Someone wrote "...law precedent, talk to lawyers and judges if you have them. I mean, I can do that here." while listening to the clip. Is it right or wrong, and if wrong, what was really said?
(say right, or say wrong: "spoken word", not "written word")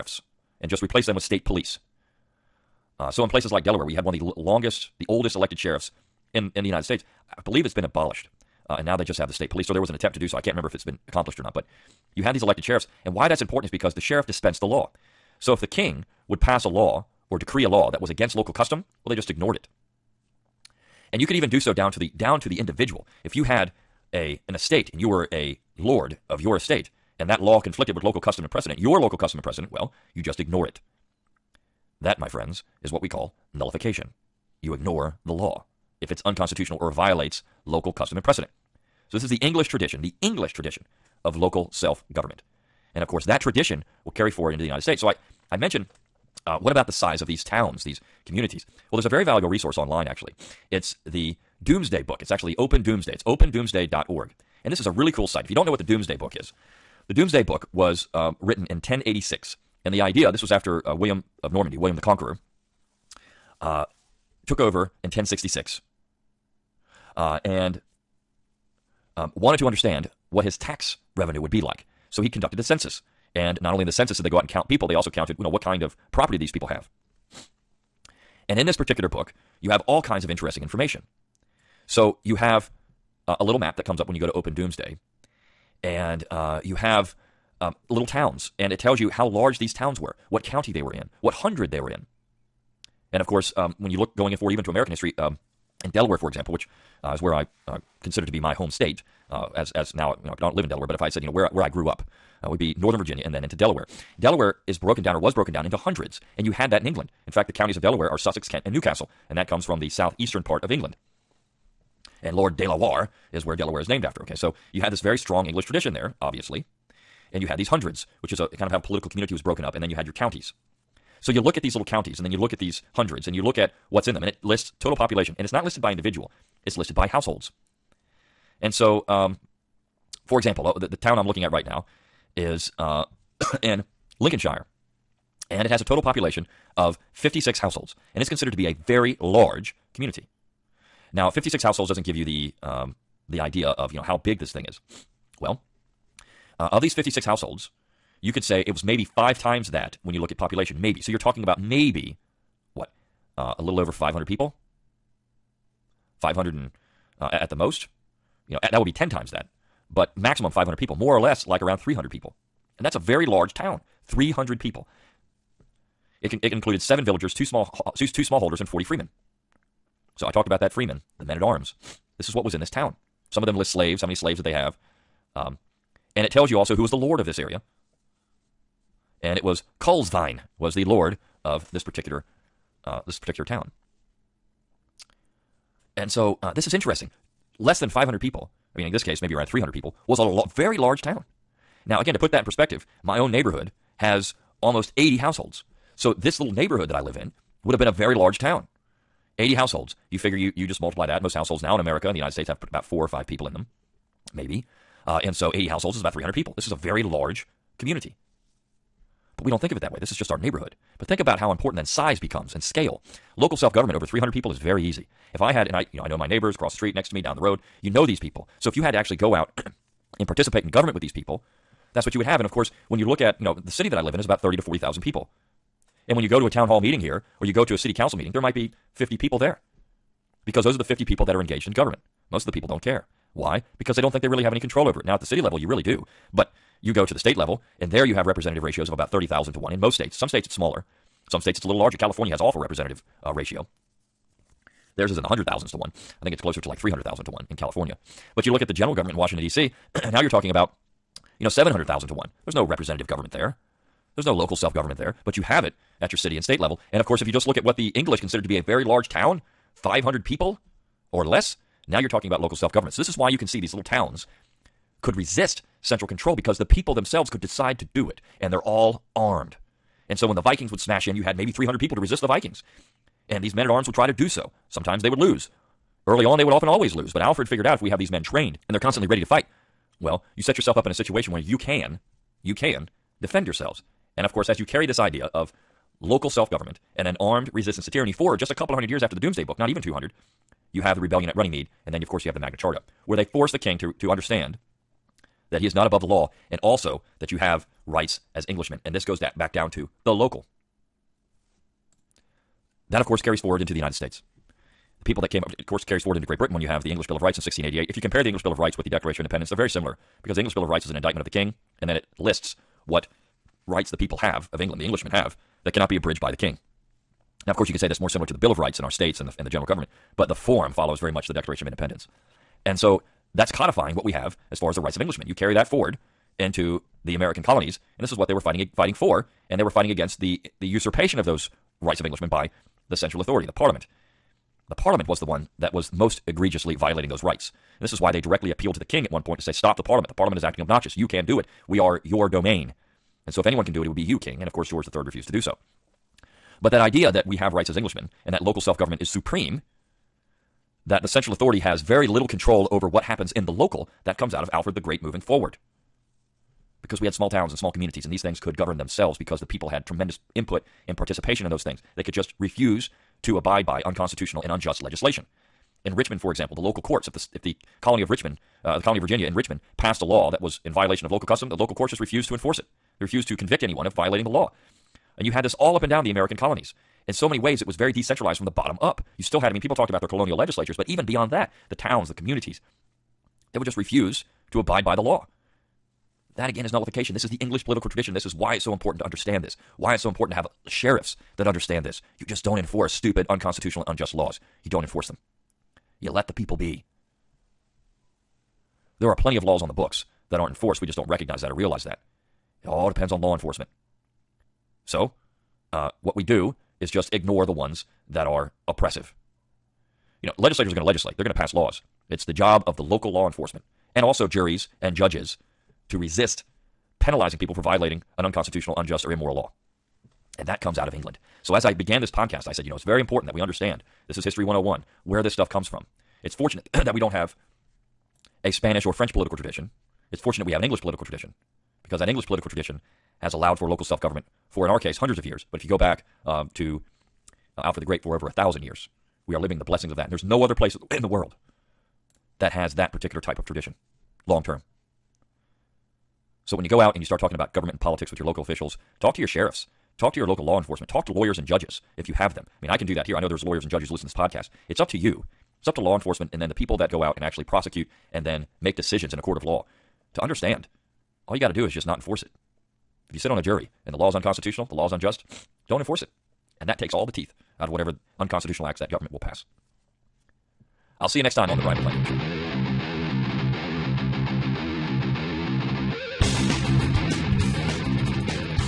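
wrong: "enforcement", not "precedent".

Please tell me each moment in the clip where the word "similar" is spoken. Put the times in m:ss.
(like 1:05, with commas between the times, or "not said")
5:09, 5:18.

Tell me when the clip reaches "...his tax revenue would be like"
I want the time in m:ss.
1:10.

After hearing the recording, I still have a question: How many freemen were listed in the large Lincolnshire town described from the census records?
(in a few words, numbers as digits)
40.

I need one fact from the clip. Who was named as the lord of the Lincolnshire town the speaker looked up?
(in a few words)
Culsvine.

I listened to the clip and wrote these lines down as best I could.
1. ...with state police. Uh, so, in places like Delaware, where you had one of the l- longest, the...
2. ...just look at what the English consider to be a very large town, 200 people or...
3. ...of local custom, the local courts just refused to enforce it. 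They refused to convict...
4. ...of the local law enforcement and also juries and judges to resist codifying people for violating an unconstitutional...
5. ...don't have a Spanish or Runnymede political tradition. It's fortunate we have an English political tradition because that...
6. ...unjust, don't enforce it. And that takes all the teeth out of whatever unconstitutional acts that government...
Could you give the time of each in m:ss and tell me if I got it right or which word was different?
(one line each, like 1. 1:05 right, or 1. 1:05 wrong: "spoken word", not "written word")
1. 0:01 right
2. 4:17 wrong: "500", not "200"
3. 6:11 right
4. 6:52 wrong: "penalizing", not "codifying"
5. 7:06 wrong: "French", not "Runnymede"
6. 7:44 right.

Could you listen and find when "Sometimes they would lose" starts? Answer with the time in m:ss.
4:34.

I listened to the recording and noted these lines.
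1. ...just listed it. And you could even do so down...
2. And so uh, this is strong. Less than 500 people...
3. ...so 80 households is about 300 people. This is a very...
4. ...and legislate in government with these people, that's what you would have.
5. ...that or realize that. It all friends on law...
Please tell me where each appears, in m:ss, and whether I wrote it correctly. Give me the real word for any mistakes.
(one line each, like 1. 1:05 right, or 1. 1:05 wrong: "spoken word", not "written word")
1. 0:19 wrong: "ignored", not "listed"
2. 3:05 wrong: "interesting", not "strong"
3. 3:25 right
4. 3:40 wrong: "participate", not "legislate"
5. 6:41 wrong: "depends", not "friends".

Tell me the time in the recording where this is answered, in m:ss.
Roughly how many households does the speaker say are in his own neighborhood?
3:14.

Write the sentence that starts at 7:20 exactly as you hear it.
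And there's no other place in the world that has that particular type of tradition long term.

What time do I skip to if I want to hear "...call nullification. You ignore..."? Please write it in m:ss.
0:33.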